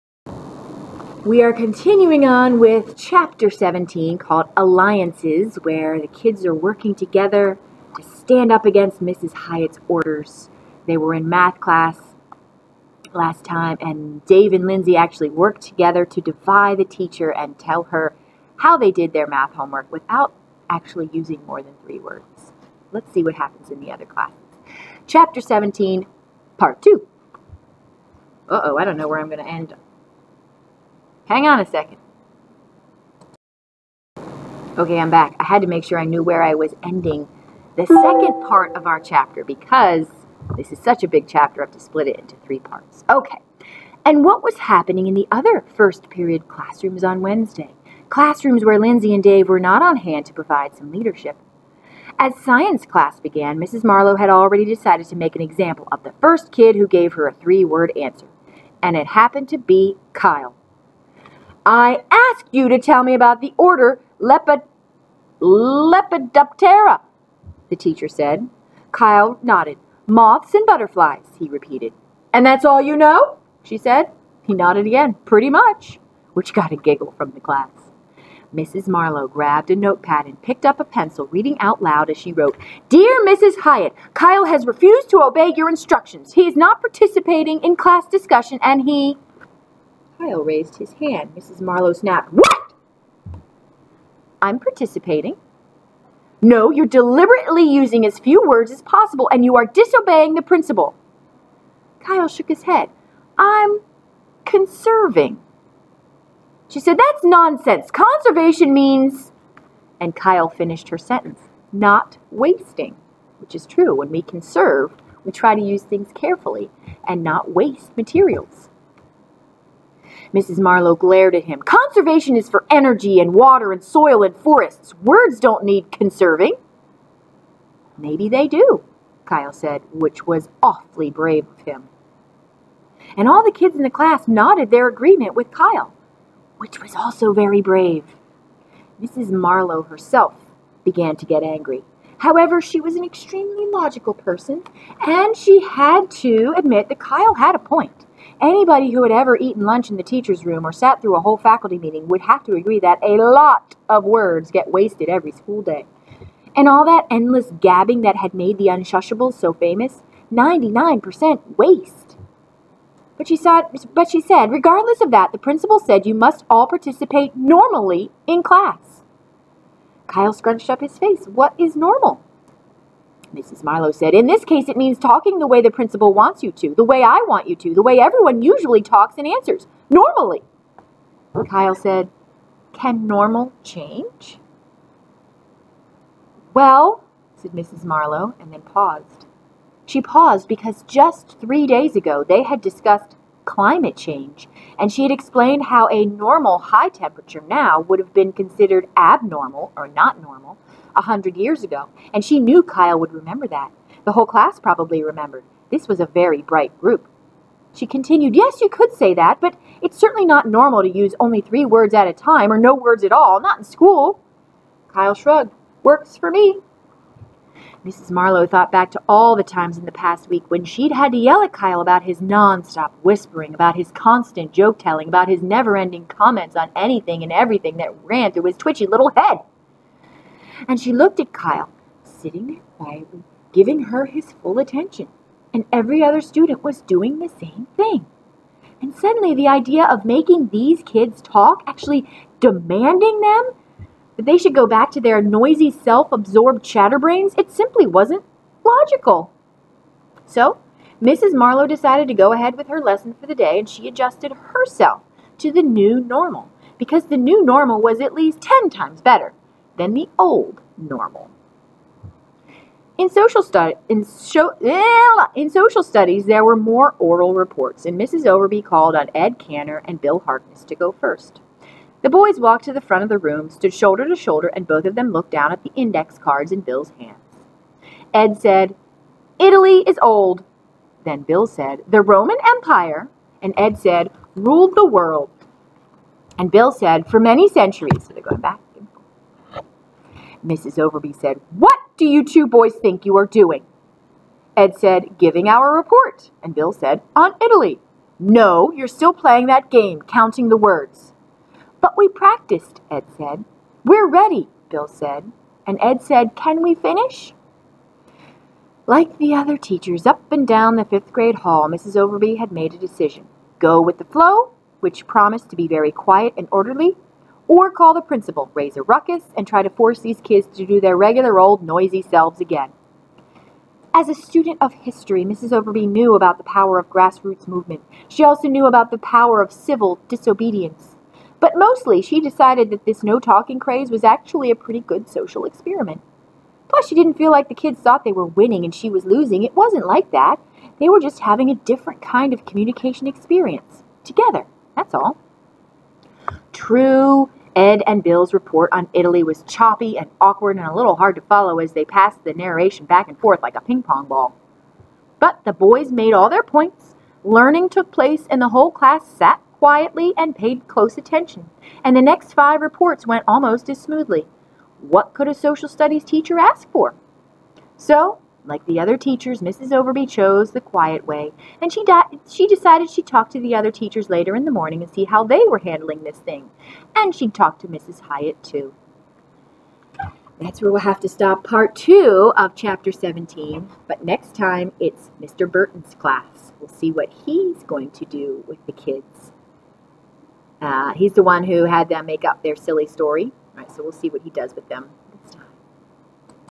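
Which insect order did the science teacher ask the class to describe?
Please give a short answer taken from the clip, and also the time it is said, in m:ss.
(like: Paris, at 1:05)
Lepidoptera, at 1:05.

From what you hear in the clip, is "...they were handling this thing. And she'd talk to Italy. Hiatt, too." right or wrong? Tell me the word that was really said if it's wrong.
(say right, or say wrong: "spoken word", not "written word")
wrong: "Mrs", not "Italy".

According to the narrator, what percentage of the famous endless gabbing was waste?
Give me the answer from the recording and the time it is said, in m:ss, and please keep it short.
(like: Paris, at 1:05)
99%, at 2:40.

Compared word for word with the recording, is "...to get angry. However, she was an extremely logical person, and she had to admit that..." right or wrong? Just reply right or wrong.
right.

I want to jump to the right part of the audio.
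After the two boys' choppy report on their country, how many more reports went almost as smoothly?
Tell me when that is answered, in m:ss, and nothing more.
6:02.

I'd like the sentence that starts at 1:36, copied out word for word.
No, you're deliberately using as few words as possible, and you are disobeying the principal.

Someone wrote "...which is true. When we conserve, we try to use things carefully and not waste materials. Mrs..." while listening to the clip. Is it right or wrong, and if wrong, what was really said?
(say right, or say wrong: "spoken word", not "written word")
right.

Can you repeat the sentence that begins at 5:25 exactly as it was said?
Overby knew about the power of grassroots movement.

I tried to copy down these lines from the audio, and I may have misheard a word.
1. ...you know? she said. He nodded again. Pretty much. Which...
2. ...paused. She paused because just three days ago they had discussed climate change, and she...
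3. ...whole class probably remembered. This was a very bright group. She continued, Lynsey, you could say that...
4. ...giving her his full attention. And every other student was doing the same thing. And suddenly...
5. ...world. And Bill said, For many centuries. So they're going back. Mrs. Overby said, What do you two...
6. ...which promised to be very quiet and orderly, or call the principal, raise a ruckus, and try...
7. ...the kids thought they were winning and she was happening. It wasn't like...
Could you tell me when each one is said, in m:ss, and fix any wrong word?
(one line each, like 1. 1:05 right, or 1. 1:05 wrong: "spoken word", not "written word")
1. 1:12 right
2. 3:08 right
3. 3:24 wrong: "Yes", not "Lynsey"
4. 3:53 right
5. 4:44 right
6. 5:14 right
7. 5:37 wrong: "losing", not "happening".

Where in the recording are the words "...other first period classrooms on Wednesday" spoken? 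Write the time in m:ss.
0:45.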